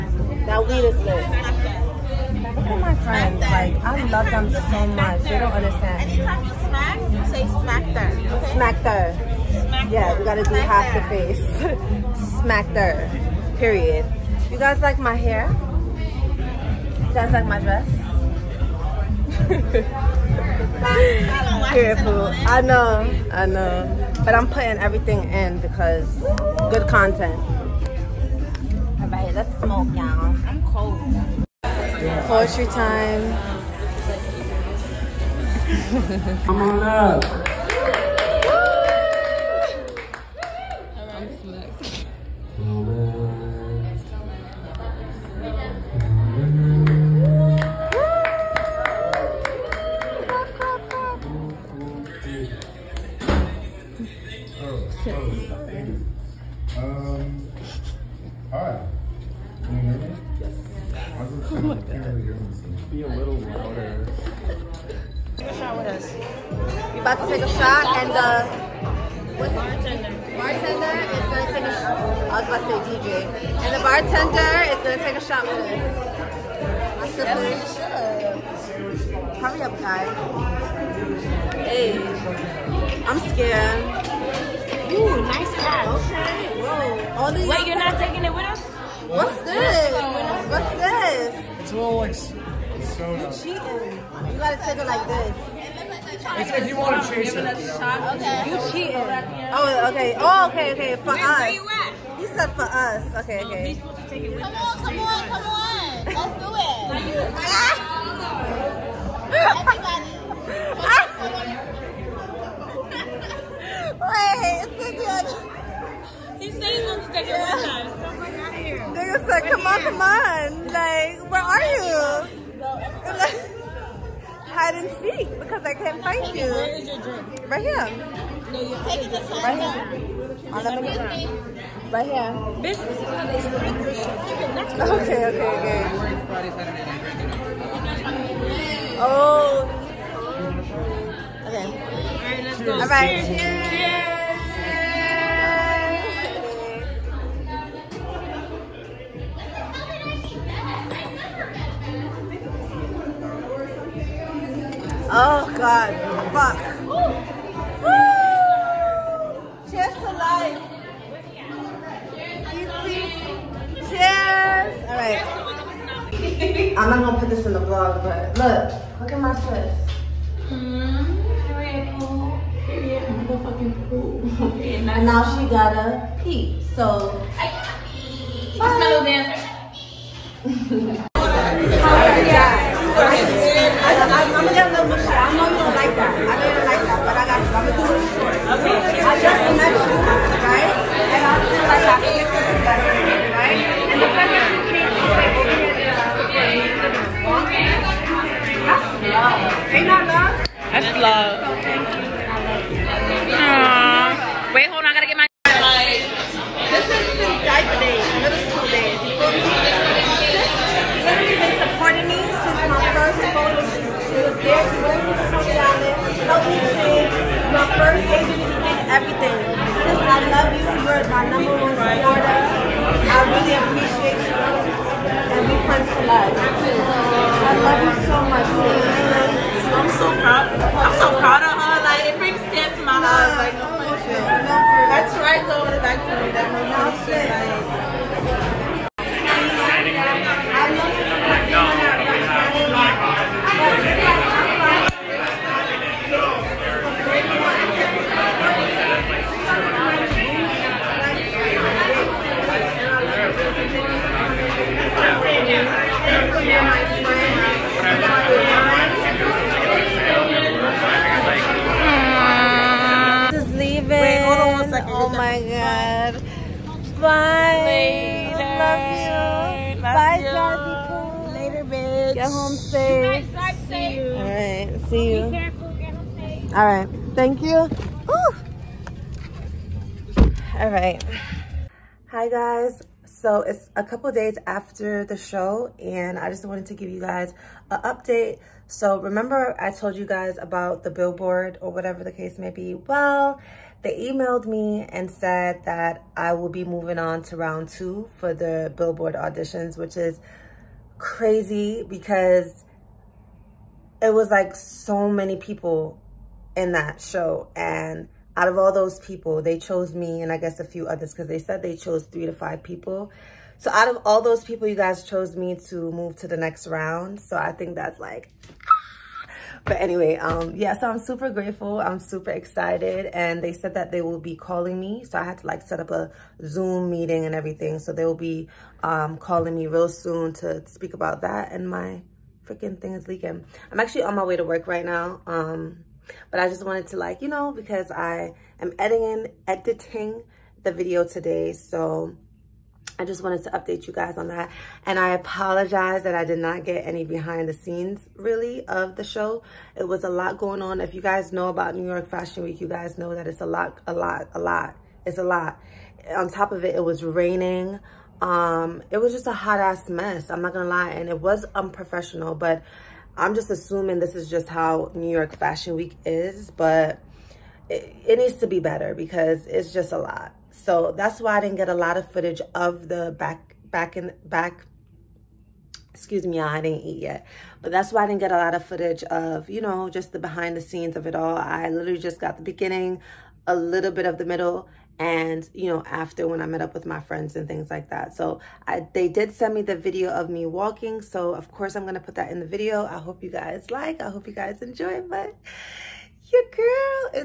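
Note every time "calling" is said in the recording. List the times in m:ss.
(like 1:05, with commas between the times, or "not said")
5:24, 5:29.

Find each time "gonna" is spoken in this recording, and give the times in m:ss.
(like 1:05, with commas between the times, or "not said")
2:47, 6:00.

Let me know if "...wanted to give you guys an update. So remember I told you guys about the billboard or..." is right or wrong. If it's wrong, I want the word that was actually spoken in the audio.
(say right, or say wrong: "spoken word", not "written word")
right.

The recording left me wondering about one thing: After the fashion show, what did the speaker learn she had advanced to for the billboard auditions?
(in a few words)
Round two.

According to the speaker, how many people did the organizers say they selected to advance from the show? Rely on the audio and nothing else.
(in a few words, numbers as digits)
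3 to 5.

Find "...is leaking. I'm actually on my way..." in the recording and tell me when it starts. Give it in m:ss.
5:32.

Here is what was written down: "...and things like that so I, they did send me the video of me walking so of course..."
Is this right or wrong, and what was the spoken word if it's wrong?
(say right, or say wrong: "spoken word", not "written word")
right.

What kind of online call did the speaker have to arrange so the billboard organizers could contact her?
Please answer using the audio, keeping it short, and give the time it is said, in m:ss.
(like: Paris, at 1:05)
Zoom meeting, at 5:26.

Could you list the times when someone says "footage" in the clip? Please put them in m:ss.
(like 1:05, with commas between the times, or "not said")
6:12, 6:18.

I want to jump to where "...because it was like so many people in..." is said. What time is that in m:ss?
5:01.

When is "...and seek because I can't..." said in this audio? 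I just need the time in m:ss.
2:04.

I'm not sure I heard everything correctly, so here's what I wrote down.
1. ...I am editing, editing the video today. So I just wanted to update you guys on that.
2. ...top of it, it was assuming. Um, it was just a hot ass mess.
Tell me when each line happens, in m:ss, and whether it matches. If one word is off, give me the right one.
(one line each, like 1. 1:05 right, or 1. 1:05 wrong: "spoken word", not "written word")
1. 5:37 right
2. 5:56 wrong: "raining", not "assuming".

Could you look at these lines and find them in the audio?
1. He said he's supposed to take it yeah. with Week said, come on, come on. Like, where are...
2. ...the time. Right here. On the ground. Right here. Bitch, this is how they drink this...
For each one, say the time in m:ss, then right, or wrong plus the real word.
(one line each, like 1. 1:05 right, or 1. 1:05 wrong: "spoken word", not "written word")
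1. 1:56 wrong: "Nigga", not "Week"
2. 2:09 right.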